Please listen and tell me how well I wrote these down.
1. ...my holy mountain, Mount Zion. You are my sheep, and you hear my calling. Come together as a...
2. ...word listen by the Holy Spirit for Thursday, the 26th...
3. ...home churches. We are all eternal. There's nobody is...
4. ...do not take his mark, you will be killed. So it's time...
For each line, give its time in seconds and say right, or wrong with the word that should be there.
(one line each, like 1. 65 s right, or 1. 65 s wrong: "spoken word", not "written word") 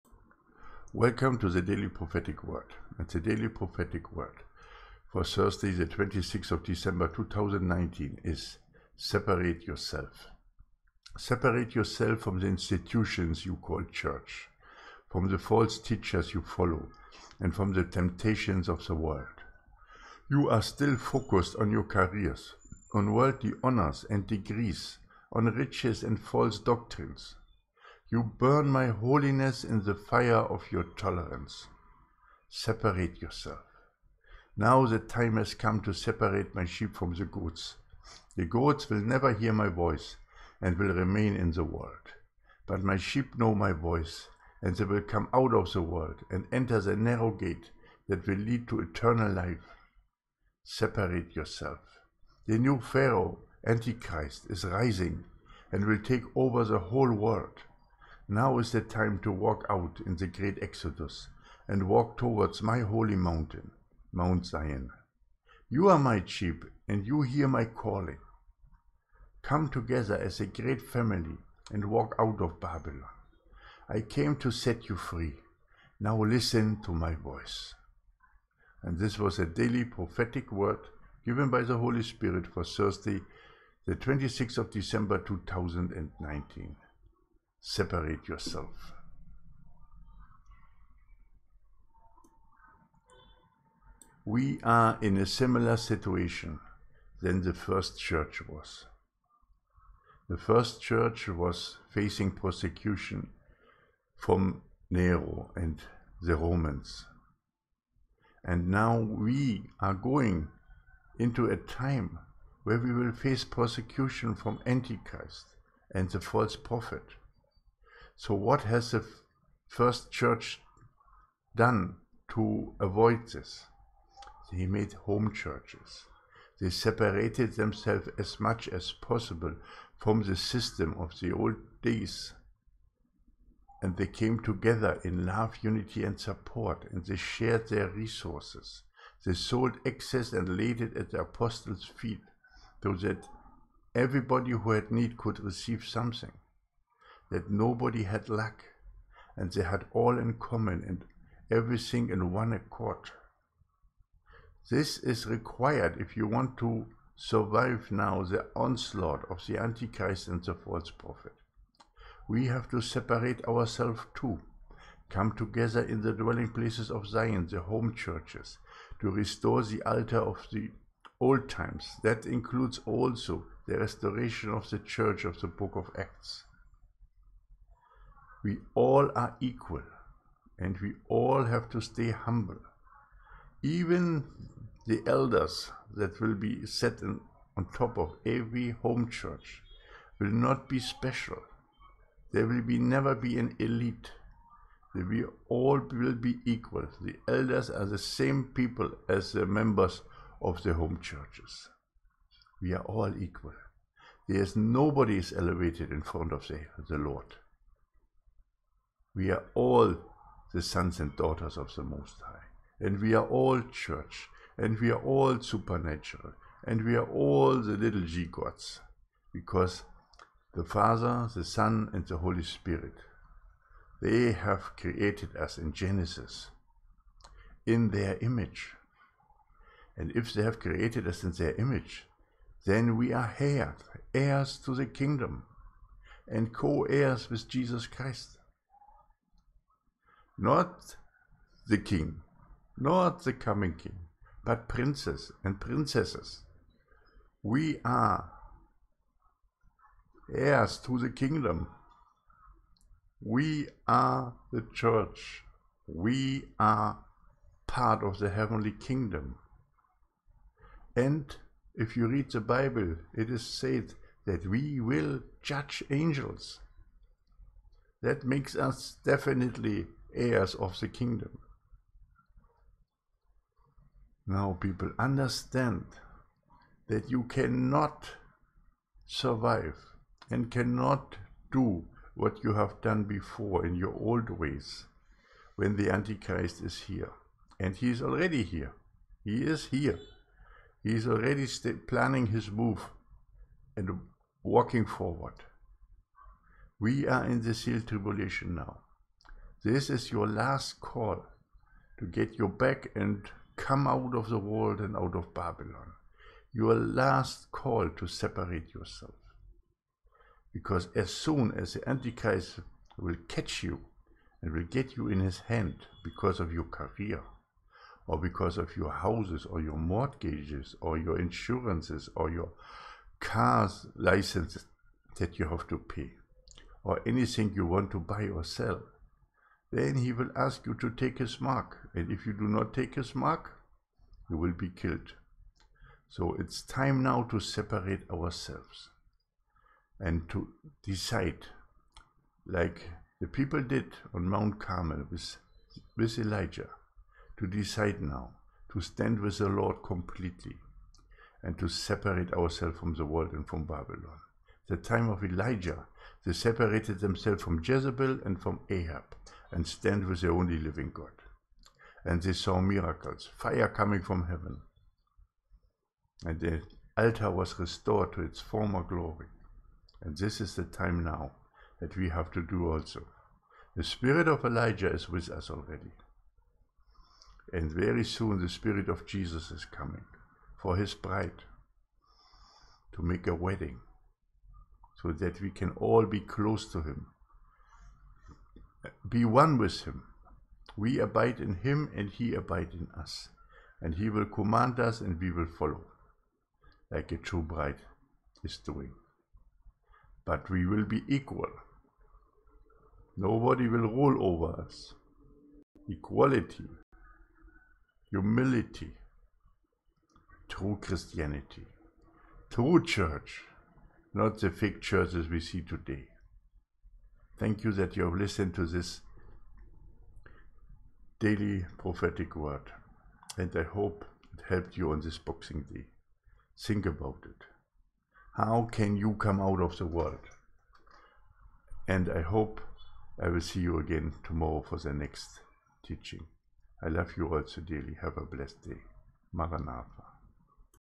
1. 62 s right
2. 80 s wrong: "given", not "listen"
3. 200 s wrong: "equal", not "eternal"
4. 332 s right.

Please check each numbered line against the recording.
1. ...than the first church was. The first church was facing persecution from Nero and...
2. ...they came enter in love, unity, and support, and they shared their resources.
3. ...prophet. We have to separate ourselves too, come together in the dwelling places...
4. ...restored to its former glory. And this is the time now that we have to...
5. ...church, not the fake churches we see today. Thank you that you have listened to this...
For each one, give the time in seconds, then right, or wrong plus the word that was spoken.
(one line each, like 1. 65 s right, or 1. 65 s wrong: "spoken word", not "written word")
1. 97 s right
2. 133 s wrong: "together", not "enter"
3. 160 s right
4. 367 s right
5. 412 s right.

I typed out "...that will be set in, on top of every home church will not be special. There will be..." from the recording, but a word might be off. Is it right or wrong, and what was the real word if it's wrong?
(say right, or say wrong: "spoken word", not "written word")
right.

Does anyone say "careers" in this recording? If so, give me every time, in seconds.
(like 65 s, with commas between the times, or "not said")
21 s, 316 s.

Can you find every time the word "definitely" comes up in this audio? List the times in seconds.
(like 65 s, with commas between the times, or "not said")
269 s.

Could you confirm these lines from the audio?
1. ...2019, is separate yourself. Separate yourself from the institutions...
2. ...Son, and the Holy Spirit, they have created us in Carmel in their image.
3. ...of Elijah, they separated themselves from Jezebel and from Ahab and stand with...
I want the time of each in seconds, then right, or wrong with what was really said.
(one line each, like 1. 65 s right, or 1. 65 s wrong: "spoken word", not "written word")
1. 7 s right
2. 221 s wrong: "Genesis", not "Carmel"
3. 355 s right.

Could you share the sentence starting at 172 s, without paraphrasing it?
That includes also the restoration of the church of the book of Acts.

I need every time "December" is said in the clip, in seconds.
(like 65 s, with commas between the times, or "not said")
6 s, 84 s.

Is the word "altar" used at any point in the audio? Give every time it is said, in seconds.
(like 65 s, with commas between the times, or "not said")
169 s, 366 s.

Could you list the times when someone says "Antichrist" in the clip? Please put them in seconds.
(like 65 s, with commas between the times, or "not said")
53 s, 114 s, 159 s, 285 s, 311 s.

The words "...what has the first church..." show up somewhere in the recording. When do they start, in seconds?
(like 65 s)
118 s.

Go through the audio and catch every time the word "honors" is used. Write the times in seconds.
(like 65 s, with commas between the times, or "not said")
23 s.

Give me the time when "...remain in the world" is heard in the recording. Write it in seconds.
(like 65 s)
40 s.